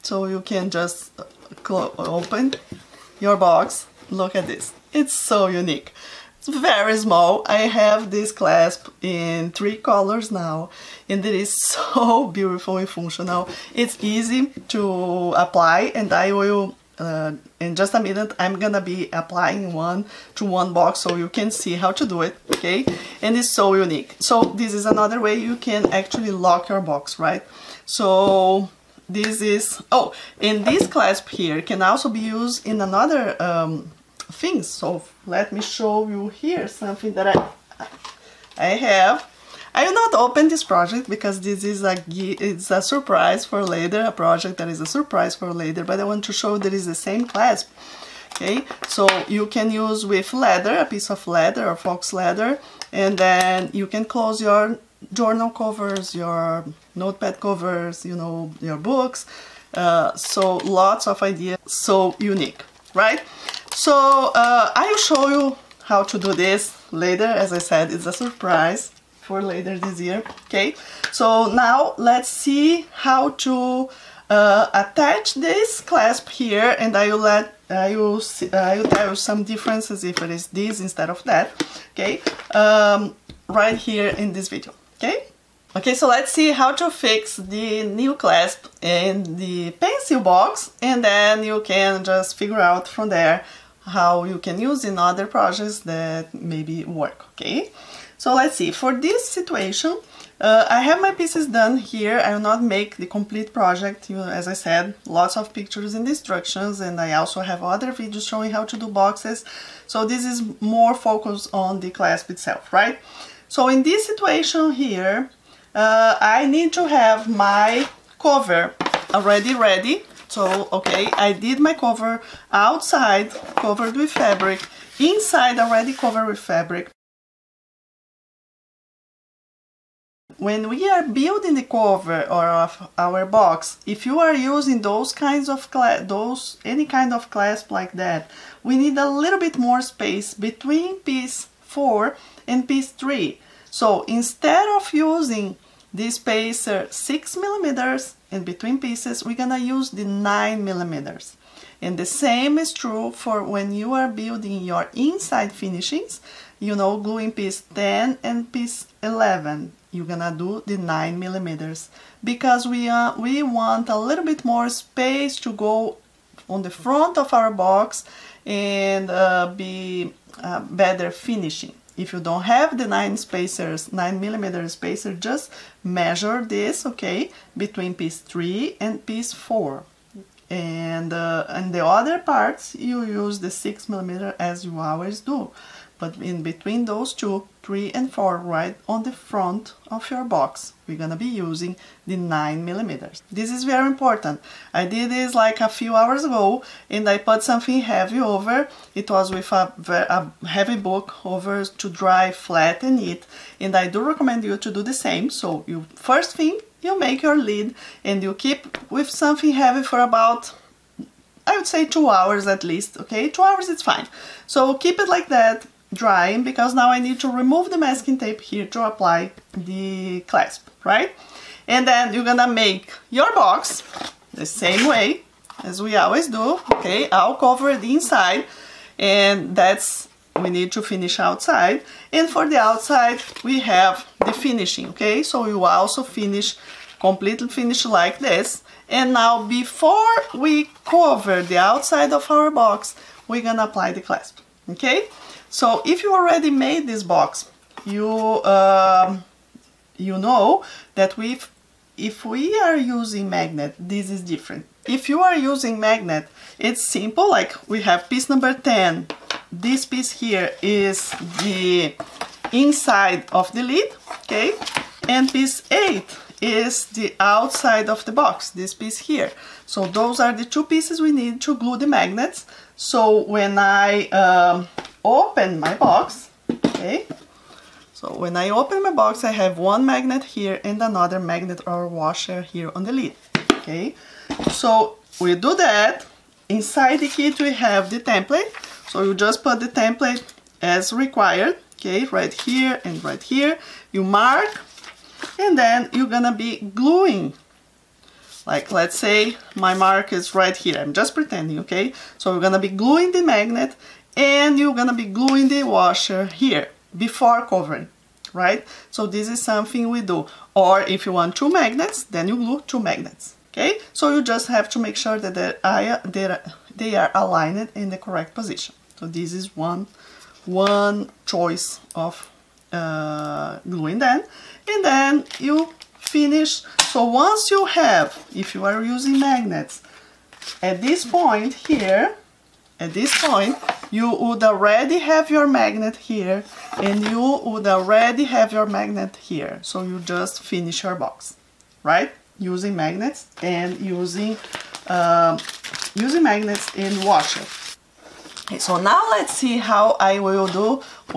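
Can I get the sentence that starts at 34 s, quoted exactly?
So let me show you here something that I, I have.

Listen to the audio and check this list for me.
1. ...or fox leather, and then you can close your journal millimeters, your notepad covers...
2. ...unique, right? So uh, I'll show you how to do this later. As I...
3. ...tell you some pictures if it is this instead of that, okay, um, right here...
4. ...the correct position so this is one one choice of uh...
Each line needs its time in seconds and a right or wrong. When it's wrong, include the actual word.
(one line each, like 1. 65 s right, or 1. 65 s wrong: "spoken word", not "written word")
1. 51 s wrong: "covers", not "millimeters"
2. 62 s right
3. 78 s wrong: "differences", not "pictures"
4. 317 s right.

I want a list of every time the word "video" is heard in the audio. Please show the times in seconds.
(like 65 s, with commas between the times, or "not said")
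84 s, 107 s.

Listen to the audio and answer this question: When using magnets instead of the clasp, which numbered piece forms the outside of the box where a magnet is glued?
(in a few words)
Piece 8.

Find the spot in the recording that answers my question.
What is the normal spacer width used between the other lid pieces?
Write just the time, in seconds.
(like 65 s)
146 s.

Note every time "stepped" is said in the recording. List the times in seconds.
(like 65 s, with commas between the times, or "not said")
not said.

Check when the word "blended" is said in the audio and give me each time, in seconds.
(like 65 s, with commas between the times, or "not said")
not said.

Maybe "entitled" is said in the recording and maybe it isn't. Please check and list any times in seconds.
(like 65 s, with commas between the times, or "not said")
not said.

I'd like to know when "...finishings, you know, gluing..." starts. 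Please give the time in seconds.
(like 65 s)
155 s.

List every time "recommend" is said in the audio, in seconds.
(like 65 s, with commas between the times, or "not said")
204 s.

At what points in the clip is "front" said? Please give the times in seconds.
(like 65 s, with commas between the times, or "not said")
166 s, 189 s.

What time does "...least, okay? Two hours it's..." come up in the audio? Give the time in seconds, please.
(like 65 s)
212 s.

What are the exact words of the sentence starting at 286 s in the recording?
Inside the kit, we have the template.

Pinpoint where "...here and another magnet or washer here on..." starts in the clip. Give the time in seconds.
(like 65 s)
280 s.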